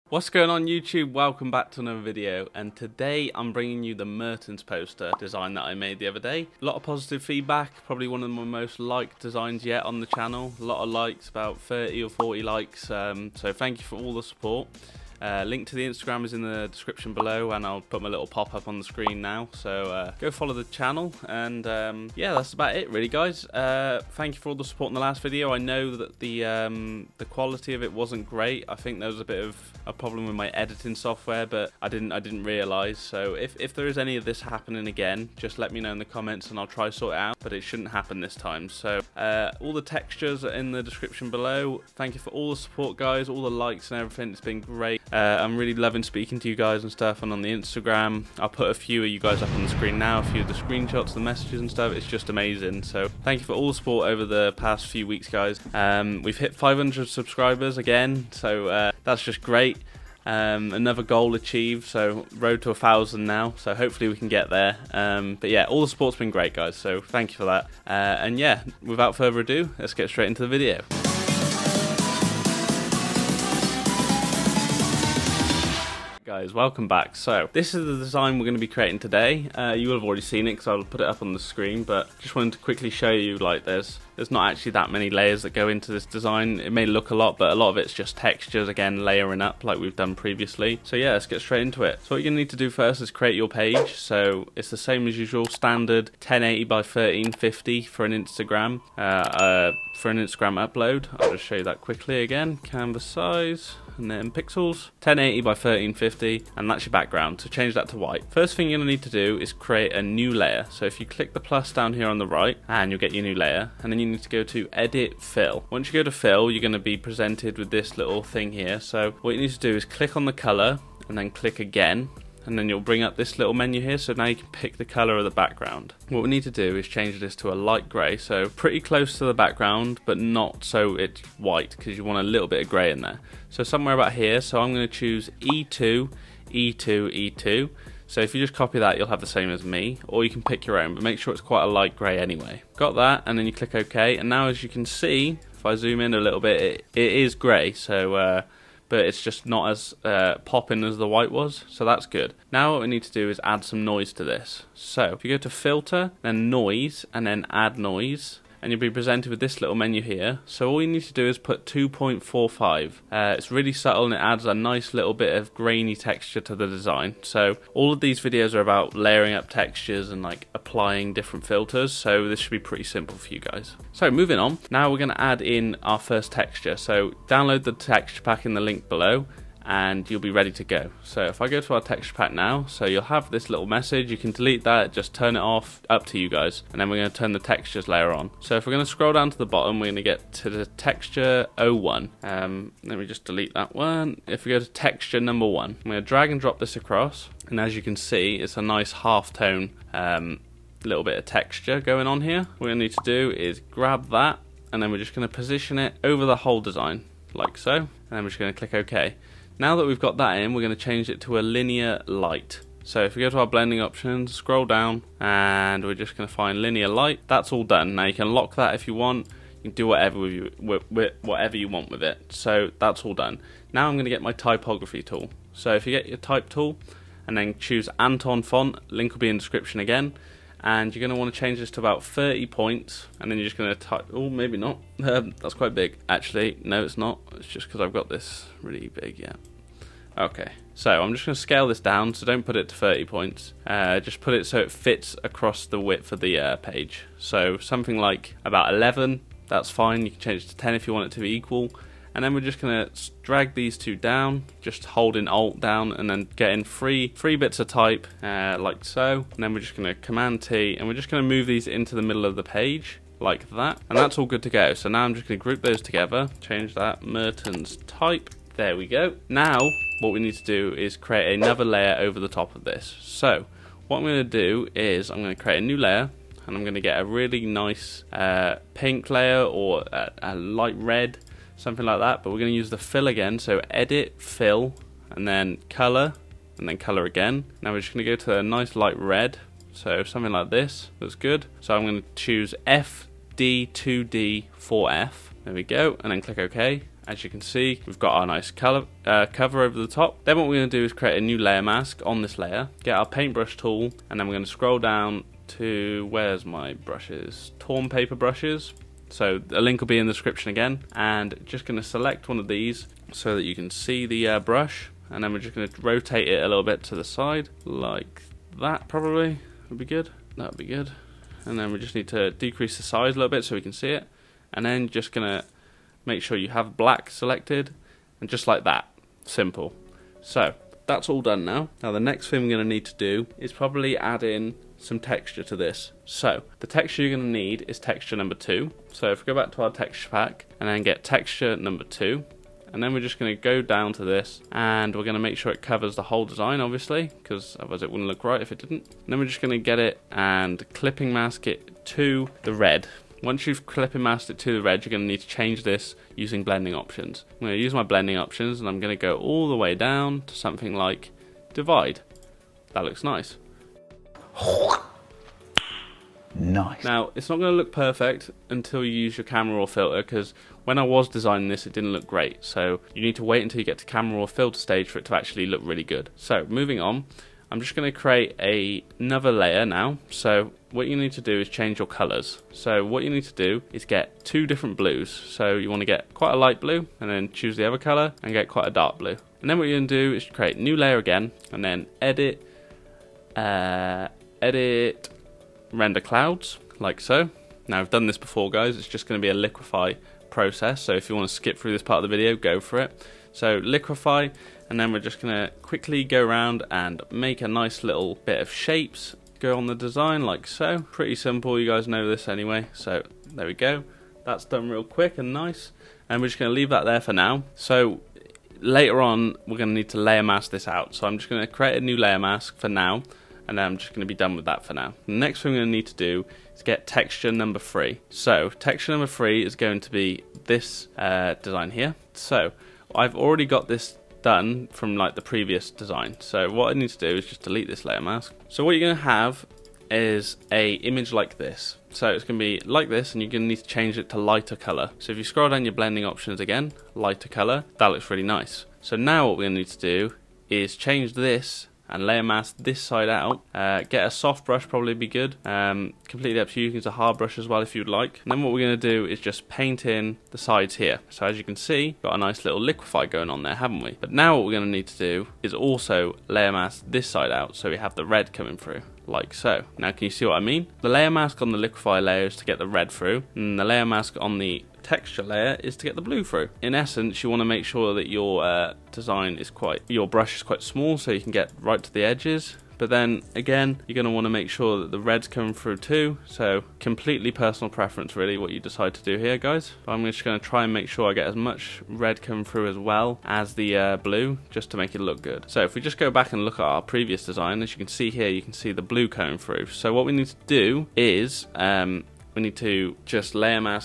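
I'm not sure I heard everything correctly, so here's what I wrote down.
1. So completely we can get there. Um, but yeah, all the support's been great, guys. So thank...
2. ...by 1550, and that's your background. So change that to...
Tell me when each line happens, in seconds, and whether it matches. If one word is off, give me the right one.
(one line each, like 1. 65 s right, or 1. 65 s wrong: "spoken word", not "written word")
1. 63 s wrong: "hopefully", not "completely"
2. 105 s wrong: "1350", not "1550".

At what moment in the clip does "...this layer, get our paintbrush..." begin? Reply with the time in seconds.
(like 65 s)
302 s.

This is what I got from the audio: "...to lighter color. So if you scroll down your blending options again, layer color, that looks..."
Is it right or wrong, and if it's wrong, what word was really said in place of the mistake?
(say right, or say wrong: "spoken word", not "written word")
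wrong: "lighter", not "layer".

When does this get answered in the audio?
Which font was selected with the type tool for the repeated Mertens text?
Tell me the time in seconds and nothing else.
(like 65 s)
227 s.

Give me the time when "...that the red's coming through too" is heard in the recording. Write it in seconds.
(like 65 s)
484 s.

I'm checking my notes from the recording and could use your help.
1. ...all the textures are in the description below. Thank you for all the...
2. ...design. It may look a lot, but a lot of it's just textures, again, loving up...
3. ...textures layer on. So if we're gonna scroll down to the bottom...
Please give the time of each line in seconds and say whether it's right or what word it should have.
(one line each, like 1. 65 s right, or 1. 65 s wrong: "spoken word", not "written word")
1. 39 s right
2. 86 s wrong: "layering", not "loving"
3. 187 s right.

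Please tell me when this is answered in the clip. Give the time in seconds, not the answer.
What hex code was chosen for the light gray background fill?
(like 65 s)
135 s.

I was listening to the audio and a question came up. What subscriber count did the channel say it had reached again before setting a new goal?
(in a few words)
500.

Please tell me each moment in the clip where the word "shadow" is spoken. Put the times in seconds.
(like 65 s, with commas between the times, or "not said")
not said.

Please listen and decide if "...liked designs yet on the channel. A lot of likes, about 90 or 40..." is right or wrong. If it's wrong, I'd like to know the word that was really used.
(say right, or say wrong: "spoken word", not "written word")
wrong: "30", not "90".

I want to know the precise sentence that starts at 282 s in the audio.
But we're going to use the fill again.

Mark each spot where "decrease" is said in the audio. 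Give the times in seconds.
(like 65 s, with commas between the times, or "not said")
322 s.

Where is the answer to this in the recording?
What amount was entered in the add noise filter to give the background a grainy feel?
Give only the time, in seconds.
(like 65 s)
161 s.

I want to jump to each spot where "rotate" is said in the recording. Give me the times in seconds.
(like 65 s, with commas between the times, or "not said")
315 s.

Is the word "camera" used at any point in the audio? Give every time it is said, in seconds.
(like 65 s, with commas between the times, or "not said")
369 s, 373 s.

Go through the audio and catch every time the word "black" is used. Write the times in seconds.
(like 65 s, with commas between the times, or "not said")
326 s.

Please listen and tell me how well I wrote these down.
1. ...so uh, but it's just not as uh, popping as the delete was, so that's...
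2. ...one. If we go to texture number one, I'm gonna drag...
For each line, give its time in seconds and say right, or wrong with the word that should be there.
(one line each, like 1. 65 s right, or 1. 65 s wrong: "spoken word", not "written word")
1. 147 s wrong: "white", not "delete"
2. 193 s right.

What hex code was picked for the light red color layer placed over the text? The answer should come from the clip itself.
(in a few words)
FD2D4F.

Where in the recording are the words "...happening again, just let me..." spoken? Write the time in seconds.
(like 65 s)
34 s.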